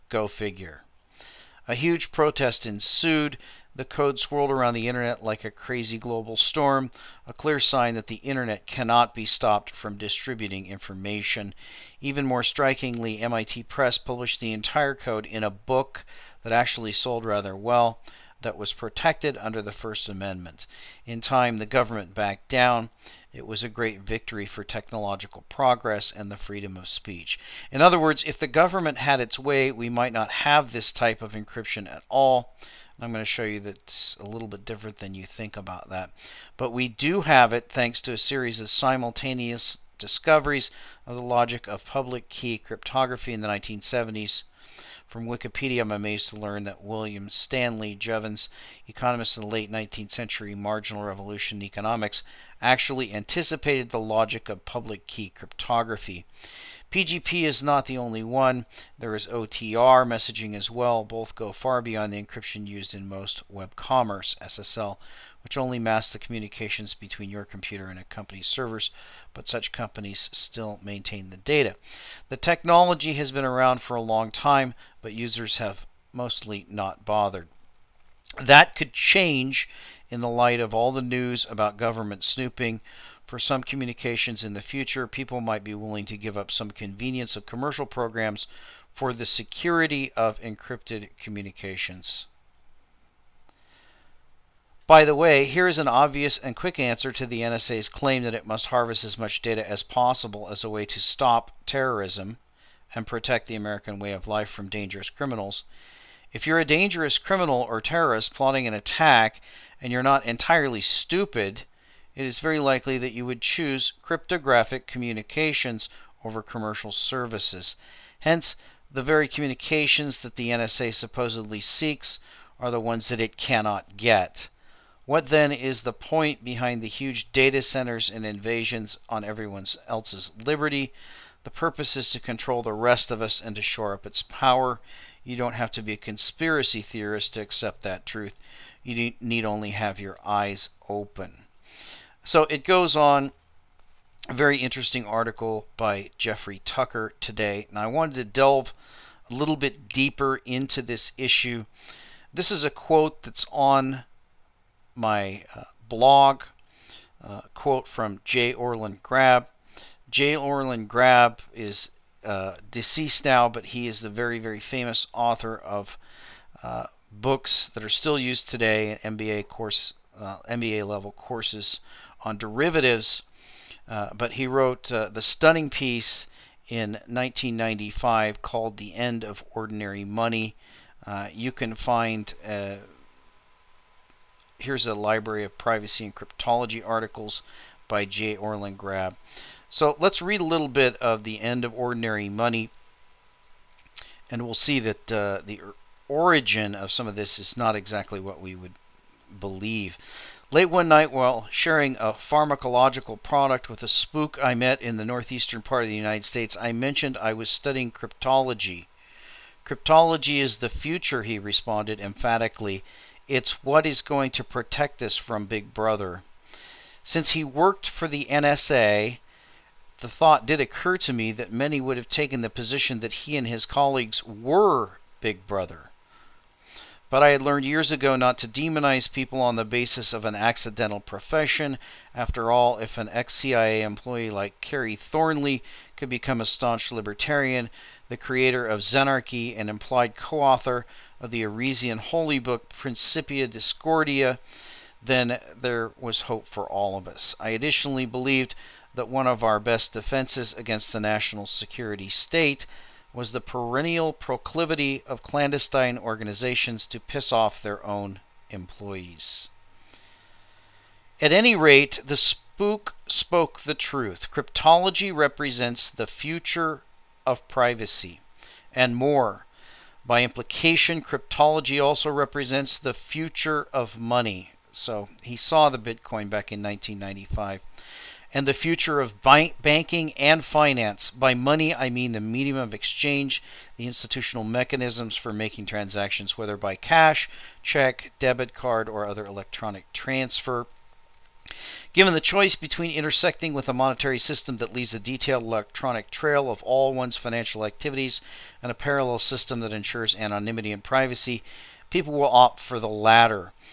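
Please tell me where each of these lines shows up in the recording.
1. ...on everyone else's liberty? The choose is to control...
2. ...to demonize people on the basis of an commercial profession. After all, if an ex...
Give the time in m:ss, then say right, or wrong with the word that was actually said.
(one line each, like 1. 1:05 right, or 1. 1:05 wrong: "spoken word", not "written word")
1. 2:09 wrong: "purpose", not "choose"
2. 3:48 wrong: "accidental", not "commercial".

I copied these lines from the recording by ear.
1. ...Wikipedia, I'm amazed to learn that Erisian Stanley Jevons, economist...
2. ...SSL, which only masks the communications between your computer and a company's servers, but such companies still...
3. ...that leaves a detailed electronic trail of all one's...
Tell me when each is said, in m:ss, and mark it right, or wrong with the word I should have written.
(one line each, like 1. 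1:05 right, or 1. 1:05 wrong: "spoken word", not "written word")
1. 0:45 wrong: "William", not "Erisian"
2. 1:04 right
3. 4:54 right.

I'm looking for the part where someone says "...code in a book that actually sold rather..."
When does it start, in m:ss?
0:14.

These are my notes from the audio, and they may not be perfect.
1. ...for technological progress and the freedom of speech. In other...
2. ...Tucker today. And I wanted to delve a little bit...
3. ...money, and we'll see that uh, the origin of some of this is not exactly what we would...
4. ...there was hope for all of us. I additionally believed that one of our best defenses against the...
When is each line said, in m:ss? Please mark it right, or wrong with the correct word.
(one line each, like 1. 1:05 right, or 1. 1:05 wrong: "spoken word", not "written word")
1. 0:24 right
2. 2:26 right
3. 3:12 right
4. 4:05 right.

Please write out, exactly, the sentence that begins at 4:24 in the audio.
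Cryptology represents the future of privacy and more.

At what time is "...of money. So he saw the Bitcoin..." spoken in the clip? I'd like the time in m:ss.
4:33.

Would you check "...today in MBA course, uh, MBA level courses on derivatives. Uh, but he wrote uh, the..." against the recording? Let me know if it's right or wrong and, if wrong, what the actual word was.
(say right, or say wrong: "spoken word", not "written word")
right.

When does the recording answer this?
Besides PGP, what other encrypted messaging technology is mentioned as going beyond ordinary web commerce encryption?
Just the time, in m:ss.
0:59.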